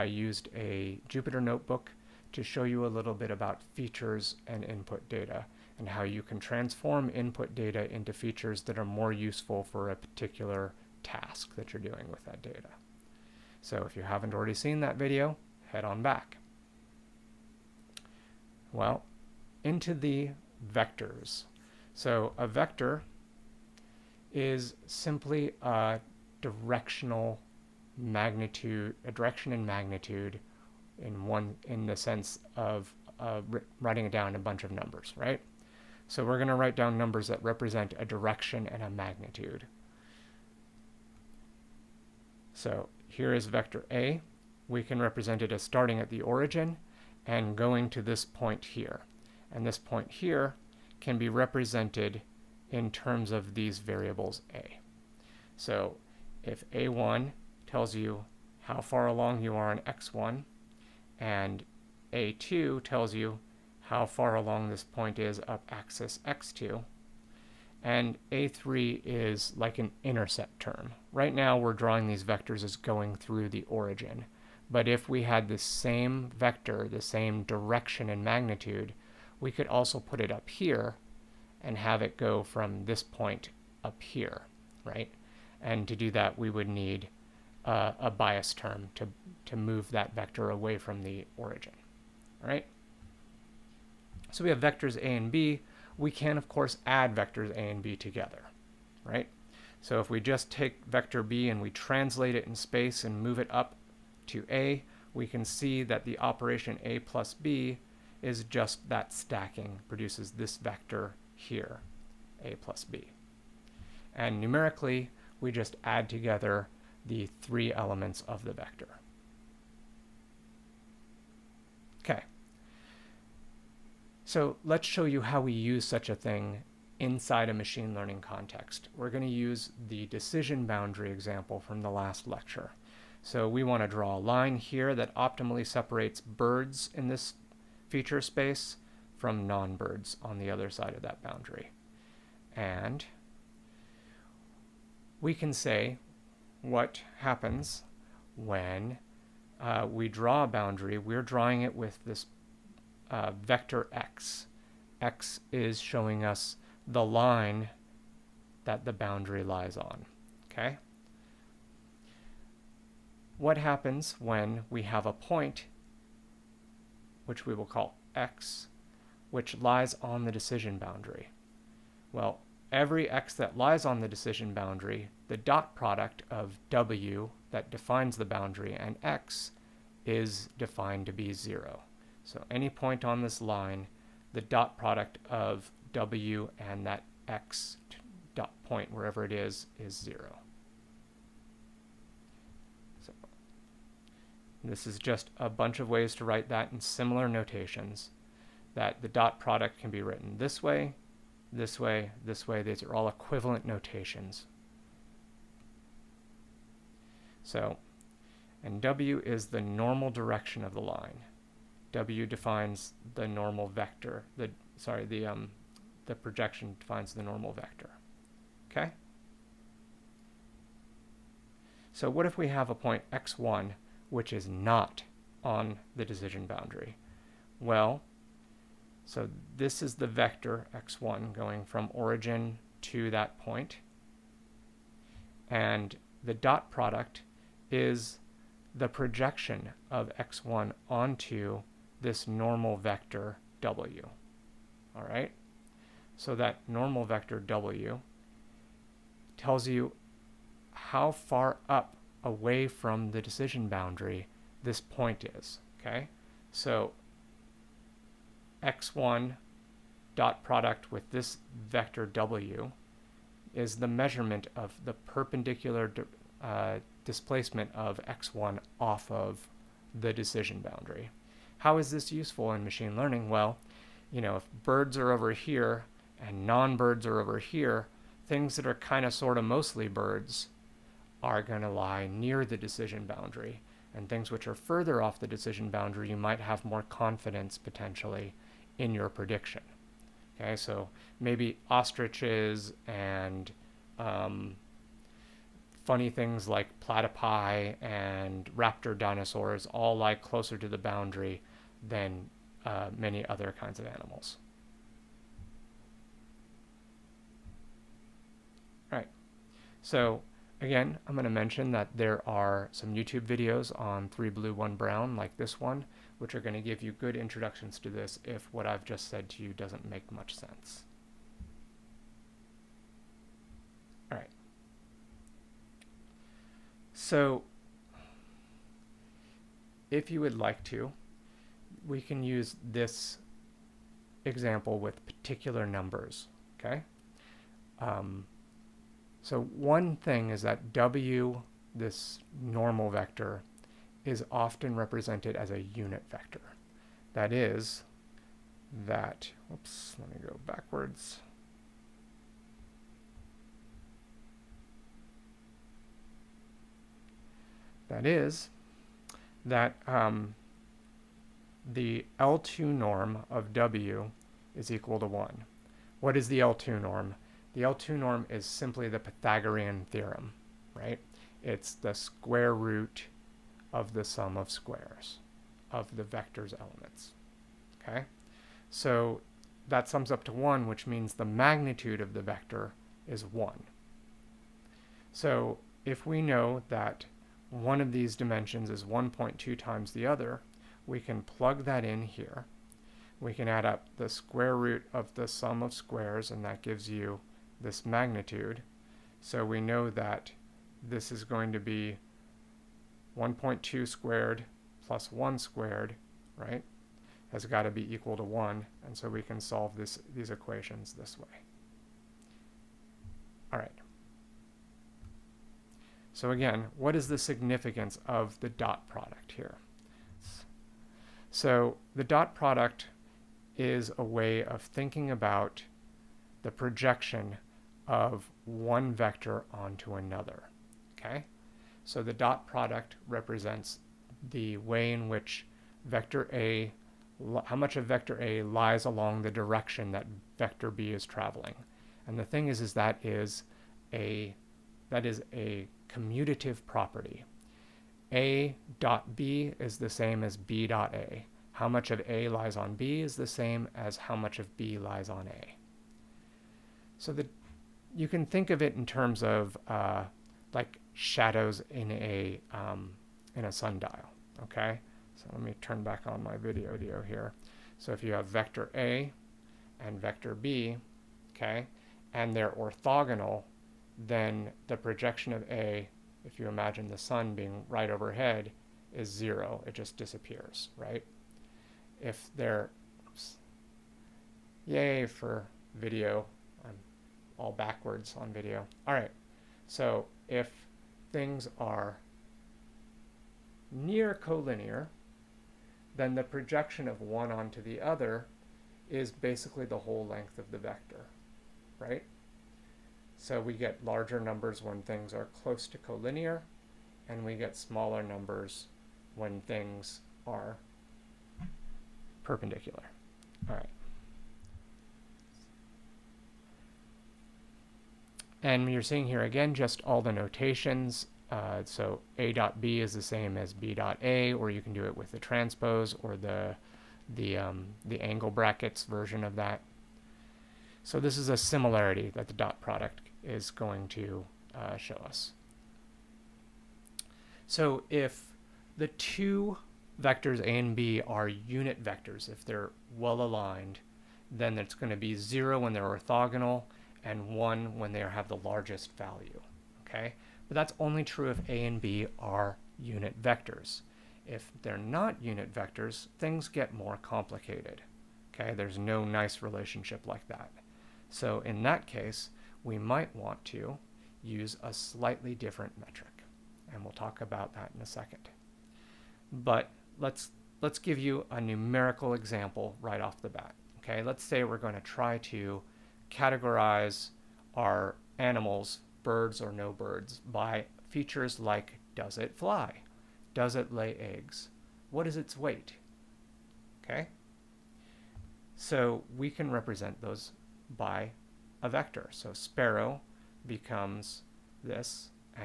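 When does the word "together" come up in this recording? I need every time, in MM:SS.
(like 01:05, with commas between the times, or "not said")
01:37, 01:56.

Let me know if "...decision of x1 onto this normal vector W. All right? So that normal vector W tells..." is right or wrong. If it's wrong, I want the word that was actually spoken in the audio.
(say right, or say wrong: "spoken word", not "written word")
wrong: "projection", not "decision".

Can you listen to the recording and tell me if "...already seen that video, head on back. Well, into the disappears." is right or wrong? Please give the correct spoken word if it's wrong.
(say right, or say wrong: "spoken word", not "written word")
wrong: "vectors", not "disappears".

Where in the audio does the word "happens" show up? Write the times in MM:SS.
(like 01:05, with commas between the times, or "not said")
02:27, 02:43.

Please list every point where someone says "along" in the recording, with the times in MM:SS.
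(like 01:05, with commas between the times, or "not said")
00:59, 01:04, 07:18.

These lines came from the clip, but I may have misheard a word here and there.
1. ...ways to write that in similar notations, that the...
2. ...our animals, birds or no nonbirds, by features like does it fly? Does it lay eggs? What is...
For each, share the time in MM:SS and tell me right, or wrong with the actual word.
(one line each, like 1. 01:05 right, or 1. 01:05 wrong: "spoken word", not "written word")
1. 03:15 right
2. 09:37 wrong: "birds", not "nonbirds".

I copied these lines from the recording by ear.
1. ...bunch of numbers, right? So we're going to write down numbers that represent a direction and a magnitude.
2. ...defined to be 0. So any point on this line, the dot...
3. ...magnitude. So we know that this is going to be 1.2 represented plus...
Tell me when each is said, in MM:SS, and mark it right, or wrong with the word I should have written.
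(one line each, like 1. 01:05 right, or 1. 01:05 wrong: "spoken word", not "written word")
1. 00:34 right
2. 03:00 right
3. 06:37 wrong: "squared", not "represented".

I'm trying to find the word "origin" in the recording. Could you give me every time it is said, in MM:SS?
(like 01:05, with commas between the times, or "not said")
00:46, 01:13, 01:31, 03:51.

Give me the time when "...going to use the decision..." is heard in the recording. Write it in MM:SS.
02:09.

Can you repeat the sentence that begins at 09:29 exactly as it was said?
But let's, let's give you a numerical example right off the bat.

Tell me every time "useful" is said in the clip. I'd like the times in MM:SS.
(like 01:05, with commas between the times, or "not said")
00:09, 04:32.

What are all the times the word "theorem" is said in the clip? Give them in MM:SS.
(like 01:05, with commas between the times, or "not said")
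06:09.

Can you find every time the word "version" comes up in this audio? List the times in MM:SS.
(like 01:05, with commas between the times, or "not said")
08:48.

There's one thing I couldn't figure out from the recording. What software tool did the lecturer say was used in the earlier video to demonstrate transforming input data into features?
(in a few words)
Jupyter notebook.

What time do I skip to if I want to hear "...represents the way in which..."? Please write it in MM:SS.
07:13.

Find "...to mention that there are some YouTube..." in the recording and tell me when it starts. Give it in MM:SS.
05:11.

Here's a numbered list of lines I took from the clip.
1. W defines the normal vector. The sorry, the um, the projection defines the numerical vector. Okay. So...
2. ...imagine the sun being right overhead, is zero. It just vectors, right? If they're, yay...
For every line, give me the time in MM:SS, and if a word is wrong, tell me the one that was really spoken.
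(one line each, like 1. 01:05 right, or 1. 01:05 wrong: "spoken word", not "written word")
1. 03:31 wrong: "normal", not "numerical"
2. 07:56 wrong: "disappears", not "vectors".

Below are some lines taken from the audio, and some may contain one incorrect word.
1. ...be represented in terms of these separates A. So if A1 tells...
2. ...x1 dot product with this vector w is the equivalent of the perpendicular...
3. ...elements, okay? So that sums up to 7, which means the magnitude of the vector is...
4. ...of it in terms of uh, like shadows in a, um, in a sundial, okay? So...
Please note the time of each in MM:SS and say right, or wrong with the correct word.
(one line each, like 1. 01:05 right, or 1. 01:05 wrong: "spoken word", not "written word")
1. 00:51 wrong: "variables", not "separates"
2. 04:18 wrong: "measurement", not "equivalent"
3. 06:16 wrong: "1", not "7"
4. 07:38 right.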